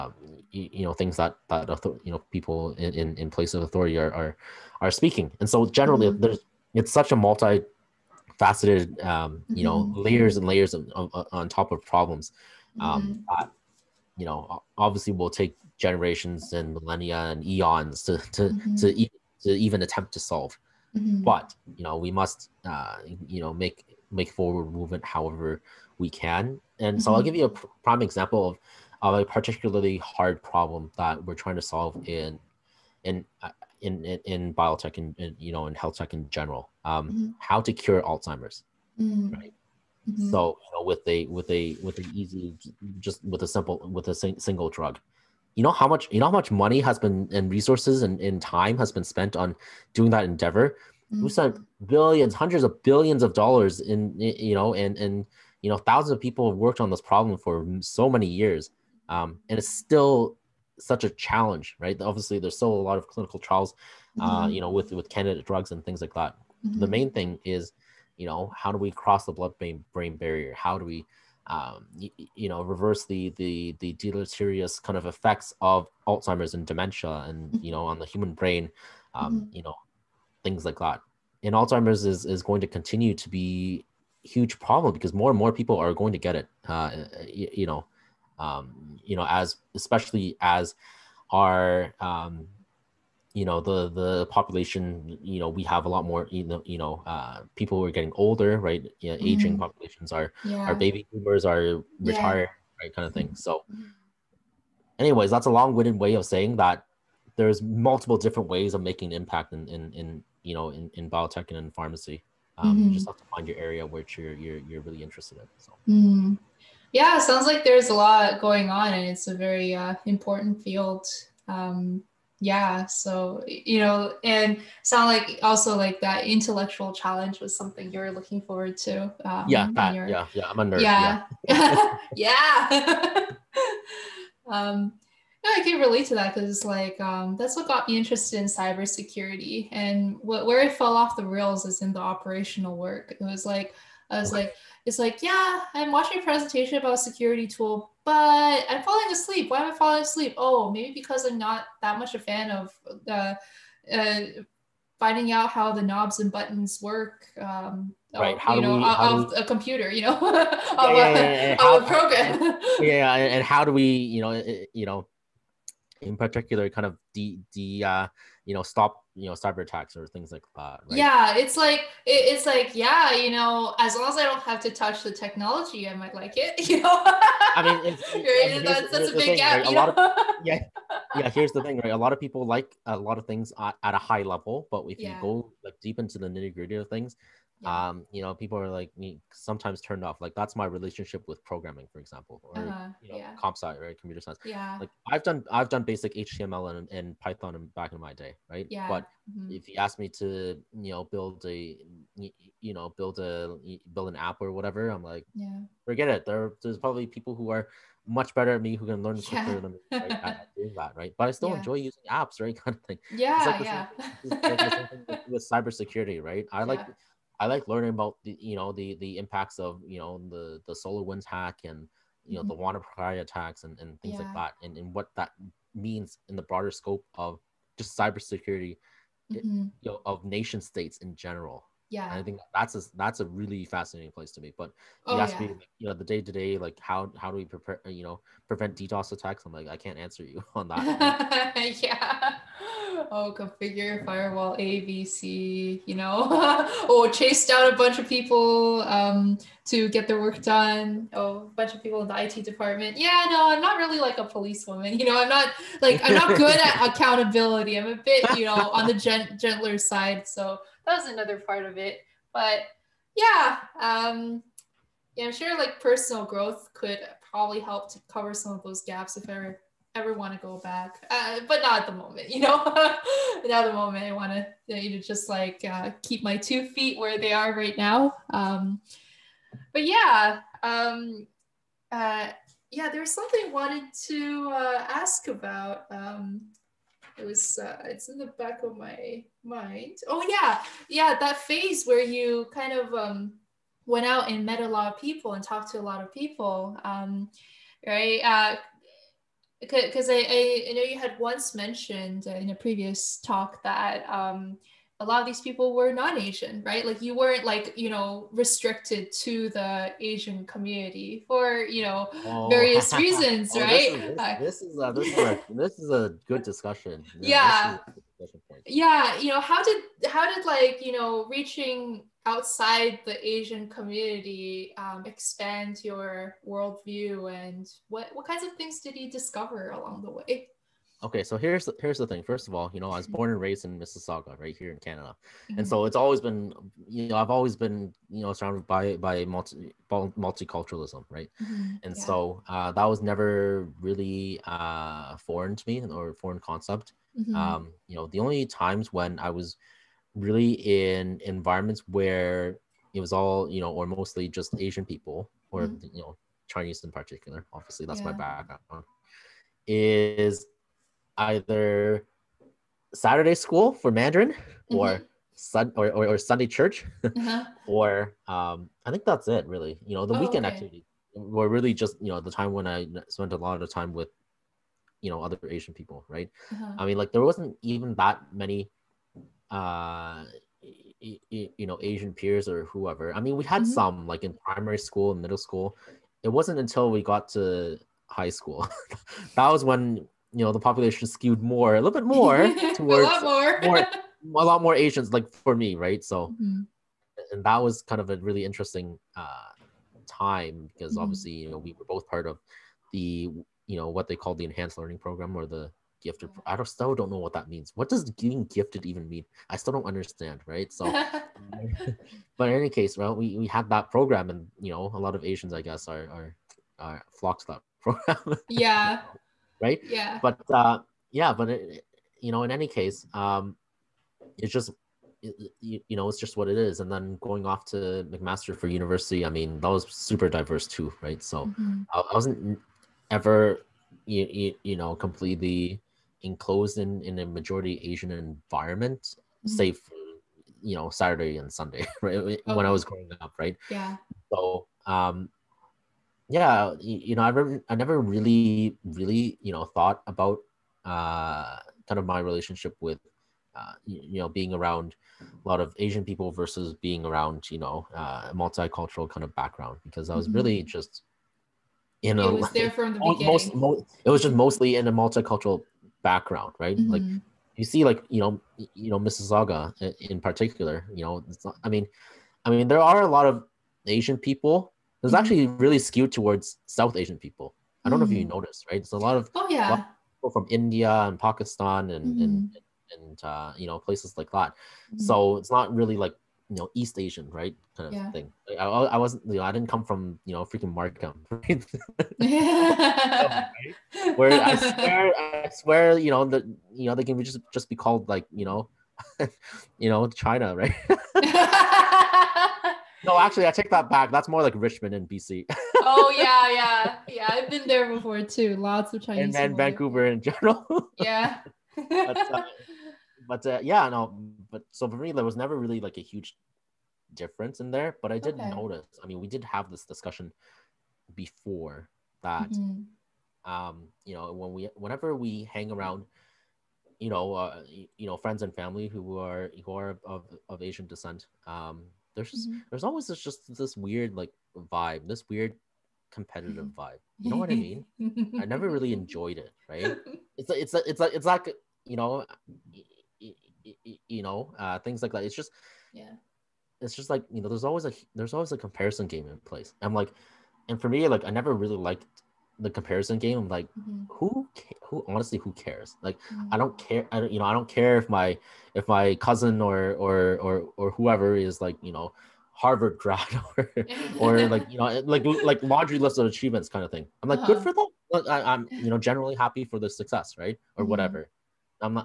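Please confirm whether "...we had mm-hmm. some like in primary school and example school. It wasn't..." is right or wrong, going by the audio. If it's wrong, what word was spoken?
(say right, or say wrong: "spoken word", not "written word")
wrong: "middle", not "example".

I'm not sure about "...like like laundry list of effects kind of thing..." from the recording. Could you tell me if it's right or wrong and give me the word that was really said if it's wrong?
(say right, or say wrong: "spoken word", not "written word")
wrong: "achievements", not "effects".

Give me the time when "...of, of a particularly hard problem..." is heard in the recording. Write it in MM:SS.
00:28.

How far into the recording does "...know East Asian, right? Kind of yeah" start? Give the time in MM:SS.
08:06.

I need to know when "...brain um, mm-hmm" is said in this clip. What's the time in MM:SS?
01:18.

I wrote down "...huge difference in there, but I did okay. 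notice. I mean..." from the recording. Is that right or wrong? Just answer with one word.
right.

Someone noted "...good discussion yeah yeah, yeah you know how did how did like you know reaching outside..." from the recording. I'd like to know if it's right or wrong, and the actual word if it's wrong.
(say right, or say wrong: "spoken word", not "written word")
right.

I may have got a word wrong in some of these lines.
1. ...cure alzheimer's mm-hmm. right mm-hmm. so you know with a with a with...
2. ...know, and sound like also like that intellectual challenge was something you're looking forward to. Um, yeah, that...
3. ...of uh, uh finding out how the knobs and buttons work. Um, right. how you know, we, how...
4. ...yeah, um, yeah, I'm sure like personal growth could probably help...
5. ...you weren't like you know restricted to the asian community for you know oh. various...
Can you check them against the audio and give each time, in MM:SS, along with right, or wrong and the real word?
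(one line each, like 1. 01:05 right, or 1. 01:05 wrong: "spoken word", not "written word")
1. 00:37 right
2. 02:03 right
3. 02:32 right
4. 04:23 right
5. 05:07 right.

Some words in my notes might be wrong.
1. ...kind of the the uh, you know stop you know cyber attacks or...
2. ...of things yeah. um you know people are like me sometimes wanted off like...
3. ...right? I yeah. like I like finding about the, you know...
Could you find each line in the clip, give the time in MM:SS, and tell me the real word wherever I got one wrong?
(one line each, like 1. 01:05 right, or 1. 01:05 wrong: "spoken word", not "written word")
1. 02:46 right
2. 03:06 wrong: "turned", not "wanted"
3. 03:36 wrong: "learning", not "finding".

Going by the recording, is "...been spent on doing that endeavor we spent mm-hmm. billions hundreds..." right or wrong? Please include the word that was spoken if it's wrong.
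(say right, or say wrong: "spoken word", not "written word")
right.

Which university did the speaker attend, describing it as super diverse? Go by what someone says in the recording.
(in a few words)
McMaster.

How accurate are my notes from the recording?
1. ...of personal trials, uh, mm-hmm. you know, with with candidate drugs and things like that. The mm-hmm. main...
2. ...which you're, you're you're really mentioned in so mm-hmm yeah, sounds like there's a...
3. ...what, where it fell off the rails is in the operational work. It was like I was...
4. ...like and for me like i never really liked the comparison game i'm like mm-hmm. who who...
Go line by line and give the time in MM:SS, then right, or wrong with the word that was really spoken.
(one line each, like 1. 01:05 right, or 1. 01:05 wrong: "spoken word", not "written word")
1. 01:02 wrong: "clinical", not "personal"
2. 01:53 wrong: "interested", not "mentioned"
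3. 02:20 right
4. 09:09 right.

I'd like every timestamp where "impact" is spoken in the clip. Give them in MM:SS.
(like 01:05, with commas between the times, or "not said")
01:49, 03:39.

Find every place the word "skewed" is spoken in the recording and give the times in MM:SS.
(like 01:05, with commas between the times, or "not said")
06:31, 07:55.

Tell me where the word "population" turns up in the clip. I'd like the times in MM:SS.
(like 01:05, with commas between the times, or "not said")
01:34, 01:39, 06:30.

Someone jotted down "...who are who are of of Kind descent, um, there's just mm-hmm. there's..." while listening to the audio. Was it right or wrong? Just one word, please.
wrong.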